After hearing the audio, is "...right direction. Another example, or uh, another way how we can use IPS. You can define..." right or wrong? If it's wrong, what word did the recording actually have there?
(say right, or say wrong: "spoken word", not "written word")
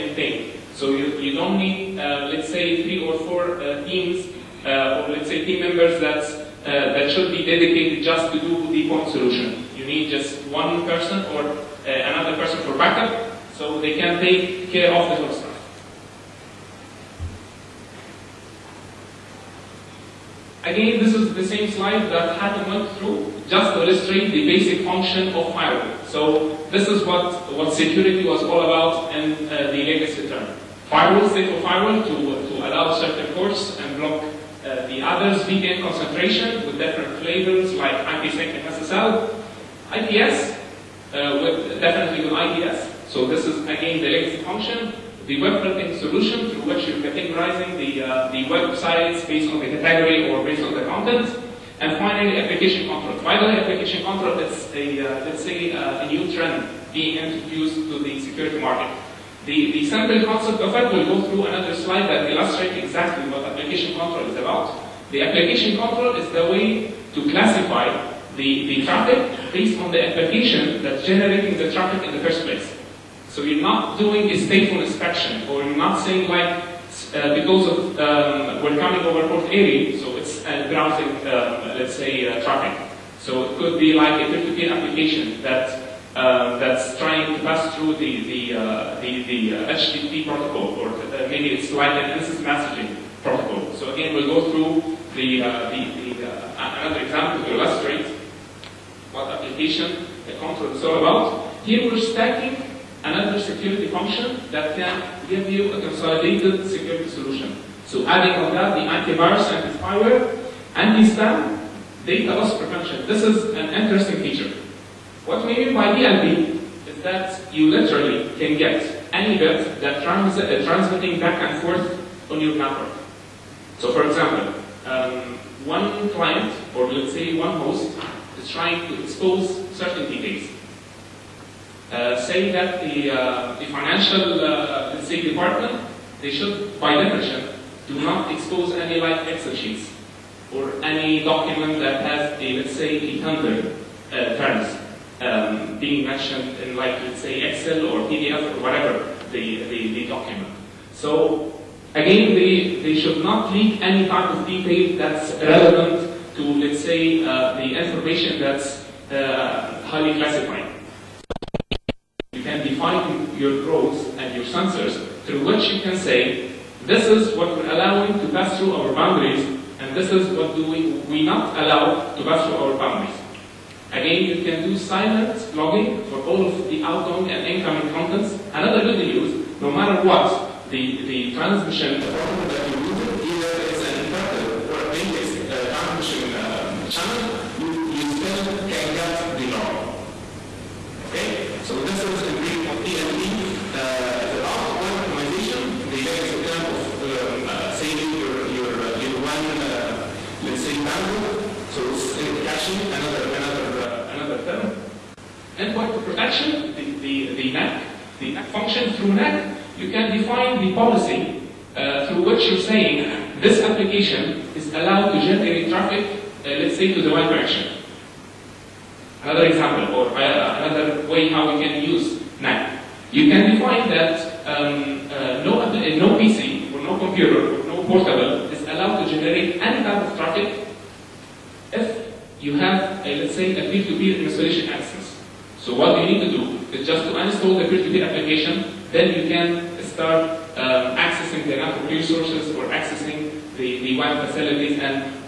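wrong: "NAC", not "IPS".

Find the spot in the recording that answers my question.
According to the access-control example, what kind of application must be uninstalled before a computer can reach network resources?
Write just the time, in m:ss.
3:57.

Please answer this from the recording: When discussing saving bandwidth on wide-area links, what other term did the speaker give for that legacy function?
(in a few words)
caching.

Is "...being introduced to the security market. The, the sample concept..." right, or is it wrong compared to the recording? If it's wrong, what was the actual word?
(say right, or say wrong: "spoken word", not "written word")
right.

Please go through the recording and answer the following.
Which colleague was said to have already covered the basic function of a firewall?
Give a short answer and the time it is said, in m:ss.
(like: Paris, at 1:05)
Hatem, at 0:22.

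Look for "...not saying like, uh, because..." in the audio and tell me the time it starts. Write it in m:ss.
1:15.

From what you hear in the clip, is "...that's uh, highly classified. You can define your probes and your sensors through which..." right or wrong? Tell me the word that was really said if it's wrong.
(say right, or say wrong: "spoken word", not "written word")
right.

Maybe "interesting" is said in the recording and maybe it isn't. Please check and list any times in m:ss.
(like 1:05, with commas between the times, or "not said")
1:53.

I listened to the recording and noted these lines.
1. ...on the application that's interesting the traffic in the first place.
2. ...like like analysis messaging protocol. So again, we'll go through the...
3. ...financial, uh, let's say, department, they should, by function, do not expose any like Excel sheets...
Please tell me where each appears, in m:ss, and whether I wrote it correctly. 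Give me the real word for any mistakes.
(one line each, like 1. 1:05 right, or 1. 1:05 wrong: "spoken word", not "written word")
1. 1:09 wrong: "generating", not "interesting"
2. 1:31 right
3. 2:13 wrong: "definition", not "function".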